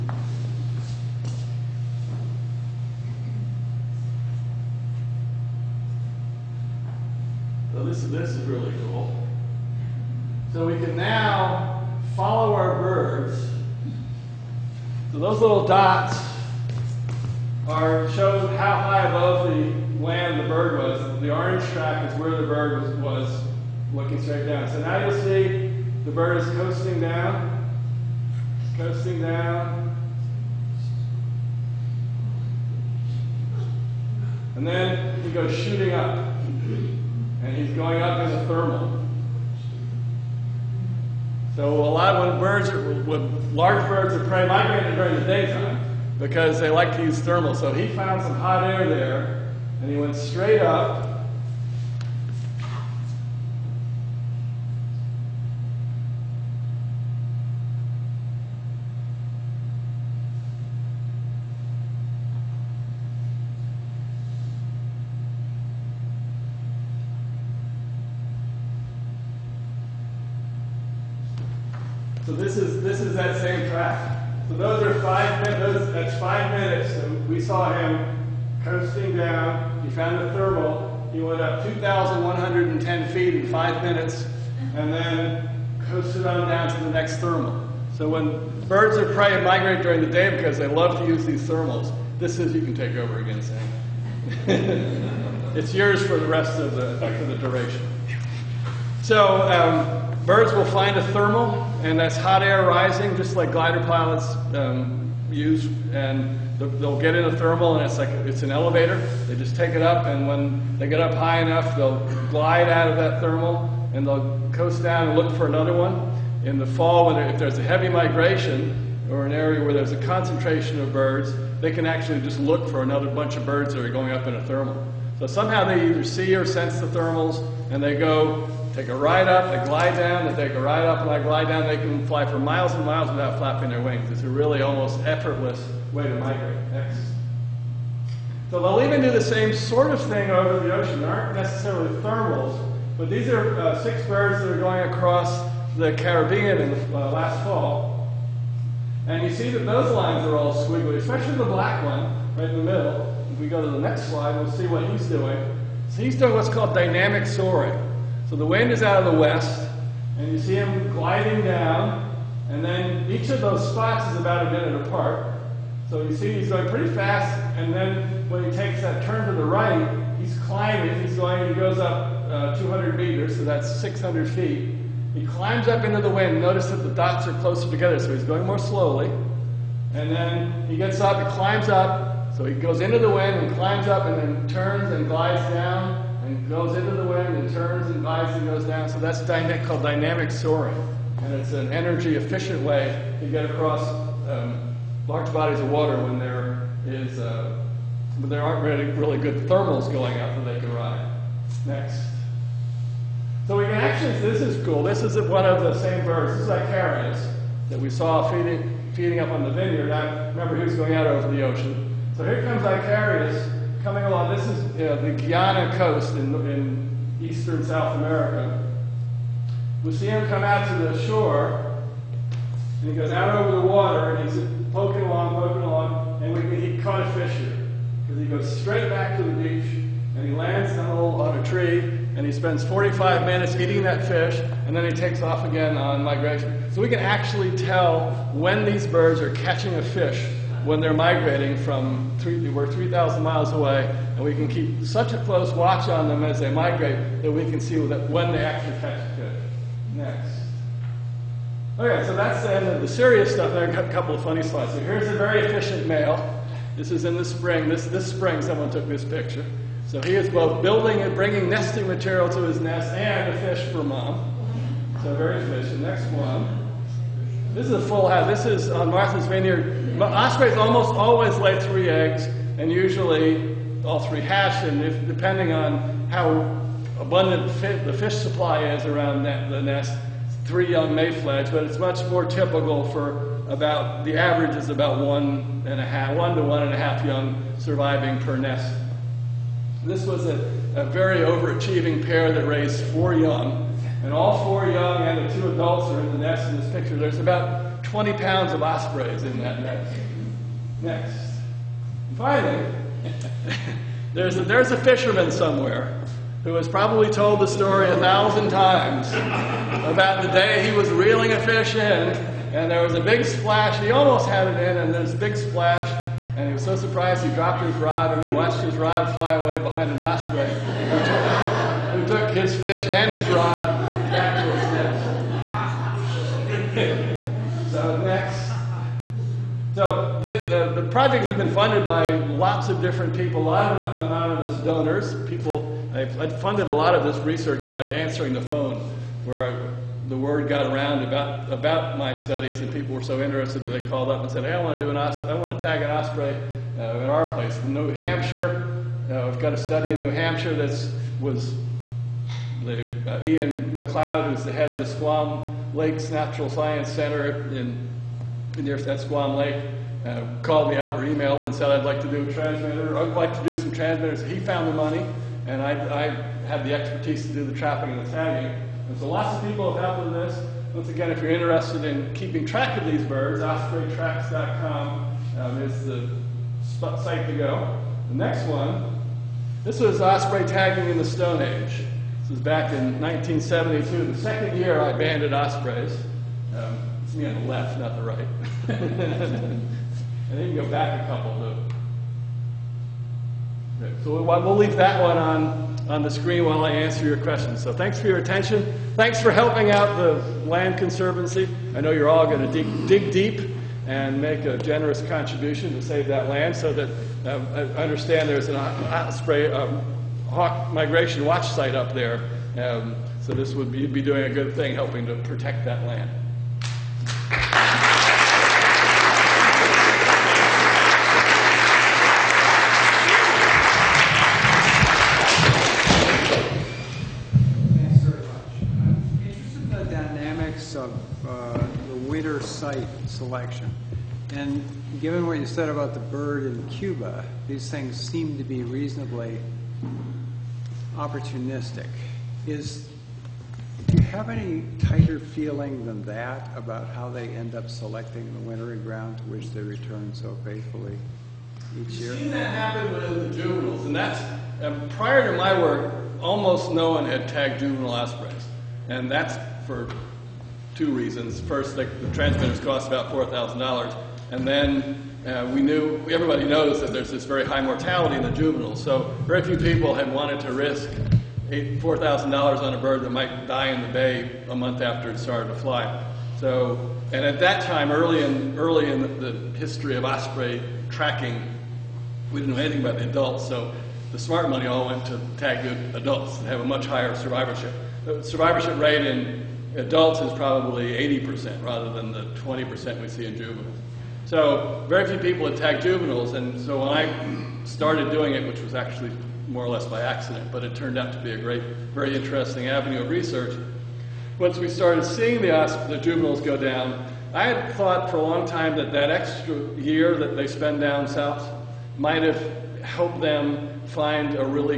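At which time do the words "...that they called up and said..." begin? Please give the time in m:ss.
5:43.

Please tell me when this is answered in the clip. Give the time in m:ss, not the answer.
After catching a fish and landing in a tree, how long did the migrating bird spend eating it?
3:52.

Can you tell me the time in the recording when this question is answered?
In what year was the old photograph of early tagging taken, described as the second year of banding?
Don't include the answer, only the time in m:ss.
6:22.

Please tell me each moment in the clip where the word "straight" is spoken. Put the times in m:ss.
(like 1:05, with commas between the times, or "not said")
0:24, 0:50, 3:48.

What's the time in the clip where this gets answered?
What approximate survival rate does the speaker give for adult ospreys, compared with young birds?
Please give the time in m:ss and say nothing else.
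8:11.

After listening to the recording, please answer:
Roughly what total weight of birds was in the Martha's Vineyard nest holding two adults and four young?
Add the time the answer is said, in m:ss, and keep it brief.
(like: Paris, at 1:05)
20 pounds, at 4:57.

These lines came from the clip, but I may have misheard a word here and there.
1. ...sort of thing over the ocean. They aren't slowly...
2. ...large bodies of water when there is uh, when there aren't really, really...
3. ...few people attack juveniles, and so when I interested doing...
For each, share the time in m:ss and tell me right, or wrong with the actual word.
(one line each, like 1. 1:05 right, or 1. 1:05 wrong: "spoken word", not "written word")
1. 2:19 wrong: "necessarily", not "slowly"
2. 3:15 right
3. 8:15 wrong: "started", not "interested".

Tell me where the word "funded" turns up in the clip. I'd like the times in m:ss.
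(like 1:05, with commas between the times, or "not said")
5:31, 5:36.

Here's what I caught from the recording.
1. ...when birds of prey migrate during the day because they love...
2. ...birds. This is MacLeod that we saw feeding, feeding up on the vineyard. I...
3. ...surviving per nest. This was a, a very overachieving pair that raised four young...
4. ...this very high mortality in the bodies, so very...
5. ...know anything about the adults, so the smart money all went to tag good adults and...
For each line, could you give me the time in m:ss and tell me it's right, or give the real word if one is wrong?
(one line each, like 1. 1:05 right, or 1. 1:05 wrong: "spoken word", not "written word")
1. 1:28 right
2. 3:26 wrong: "Icarius", not "MacLeod"
3. 4:47 right
4. 7:47 wrong: "juveniles", not "bodies"
5. 8:02 right.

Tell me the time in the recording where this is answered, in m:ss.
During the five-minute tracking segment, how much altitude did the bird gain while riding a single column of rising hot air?
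1:21.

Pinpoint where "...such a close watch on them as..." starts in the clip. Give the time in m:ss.
4:04.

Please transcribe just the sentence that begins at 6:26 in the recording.
Um, it's me on the left, not the right.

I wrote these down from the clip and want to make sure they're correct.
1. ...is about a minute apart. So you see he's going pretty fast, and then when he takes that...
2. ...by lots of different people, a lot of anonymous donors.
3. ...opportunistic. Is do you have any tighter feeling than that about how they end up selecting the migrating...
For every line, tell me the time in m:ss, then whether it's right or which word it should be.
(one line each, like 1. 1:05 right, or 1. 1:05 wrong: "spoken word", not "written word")
1. 2:44 right
2. 5:31 right
3. 7:20 wrong: "wintering", not "migrating".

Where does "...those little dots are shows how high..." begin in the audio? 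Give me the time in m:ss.
0:15.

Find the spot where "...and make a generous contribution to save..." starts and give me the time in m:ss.
6:43.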